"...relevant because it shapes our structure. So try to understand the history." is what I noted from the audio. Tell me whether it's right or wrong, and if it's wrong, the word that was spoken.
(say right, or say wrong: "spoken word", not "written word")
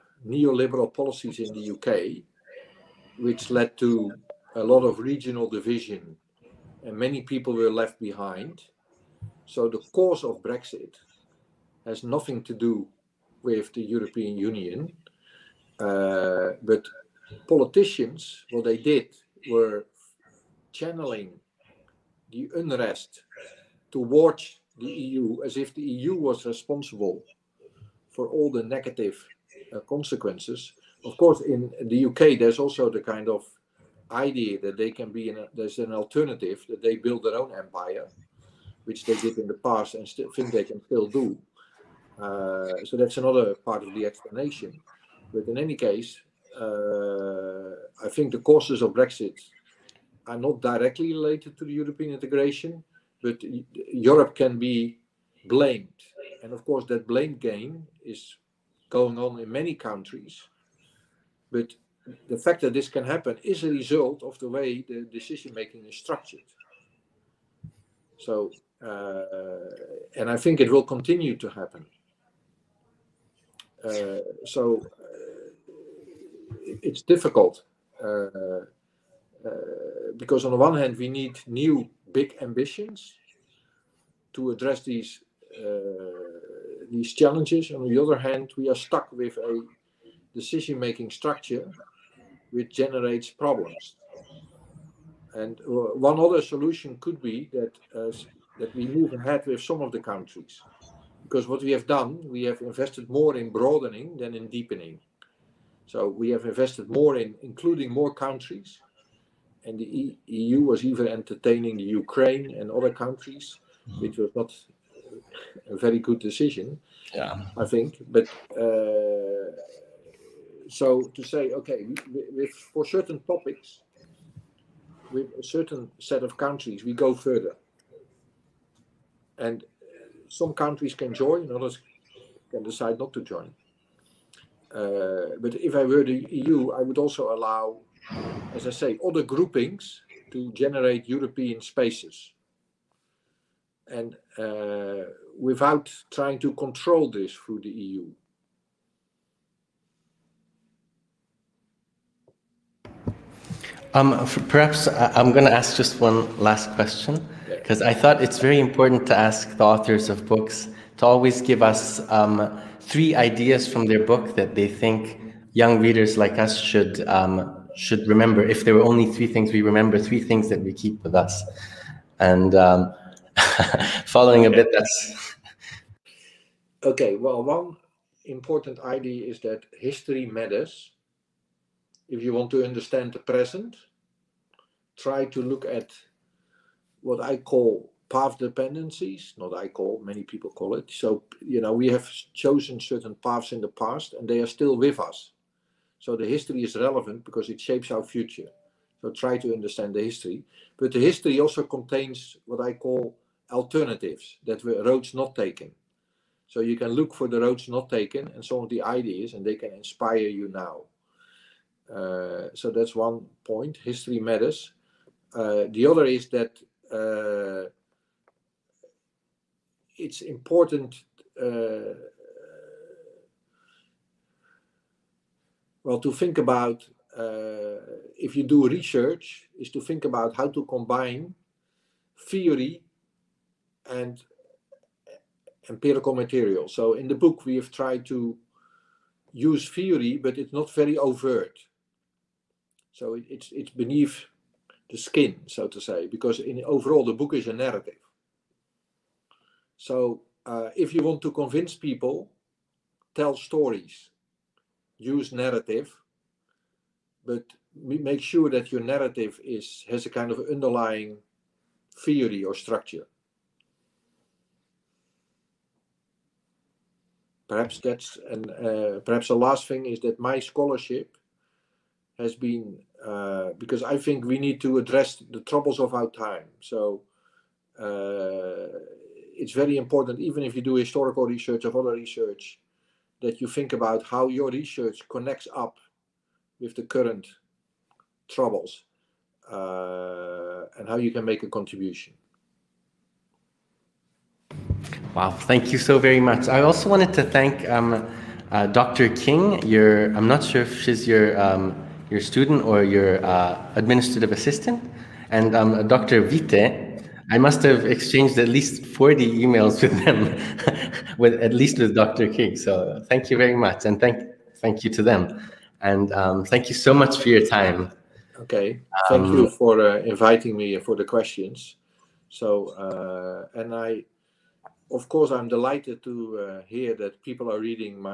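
wrong: "future", not "structure".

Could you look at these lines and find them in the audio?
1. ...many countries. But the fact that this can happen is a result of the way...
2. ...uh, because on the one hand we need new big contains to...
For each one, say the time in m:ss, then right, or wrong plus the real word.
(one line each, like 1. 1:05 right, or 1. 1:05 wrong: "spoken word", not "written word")
1. 0:59 right
2. 1:18 wrong: "ambitions", not "contains".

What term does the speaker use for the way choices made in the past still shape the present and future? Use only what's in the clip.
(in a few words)
path dependencies.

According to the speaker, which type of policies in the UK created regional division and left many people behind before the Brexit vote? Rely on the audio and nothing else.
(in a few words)
neoliberal policies.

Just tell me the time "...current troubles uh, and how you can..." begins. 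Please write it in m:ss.
4:46.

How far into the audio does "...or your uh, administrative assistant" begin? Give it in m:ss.
5:02.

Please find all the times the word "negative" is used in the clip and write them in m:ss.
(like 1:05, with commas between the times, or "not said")
0:28.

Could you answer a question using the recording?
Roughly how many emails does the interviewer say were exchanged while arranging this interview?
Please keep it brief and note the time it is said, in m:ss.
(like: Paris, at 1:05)
40, at 5:08.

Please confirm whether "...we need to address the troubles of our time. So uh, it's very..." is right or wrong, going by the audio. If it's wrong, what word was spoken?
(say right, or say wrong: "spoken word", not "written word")
right.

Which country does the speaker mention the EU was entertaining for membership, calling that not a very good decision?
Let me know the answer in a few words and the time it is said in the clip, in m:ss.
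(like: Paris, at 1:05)
Ukraine, at 1:52.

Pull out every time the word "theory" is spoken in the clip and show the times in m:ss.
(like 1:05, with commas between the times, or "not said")
3:52, 3:59, 4:22.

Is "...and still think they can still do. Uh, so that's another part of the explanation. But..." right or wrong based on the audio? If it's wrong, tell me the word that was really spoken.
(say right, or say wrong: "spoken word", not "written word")
right.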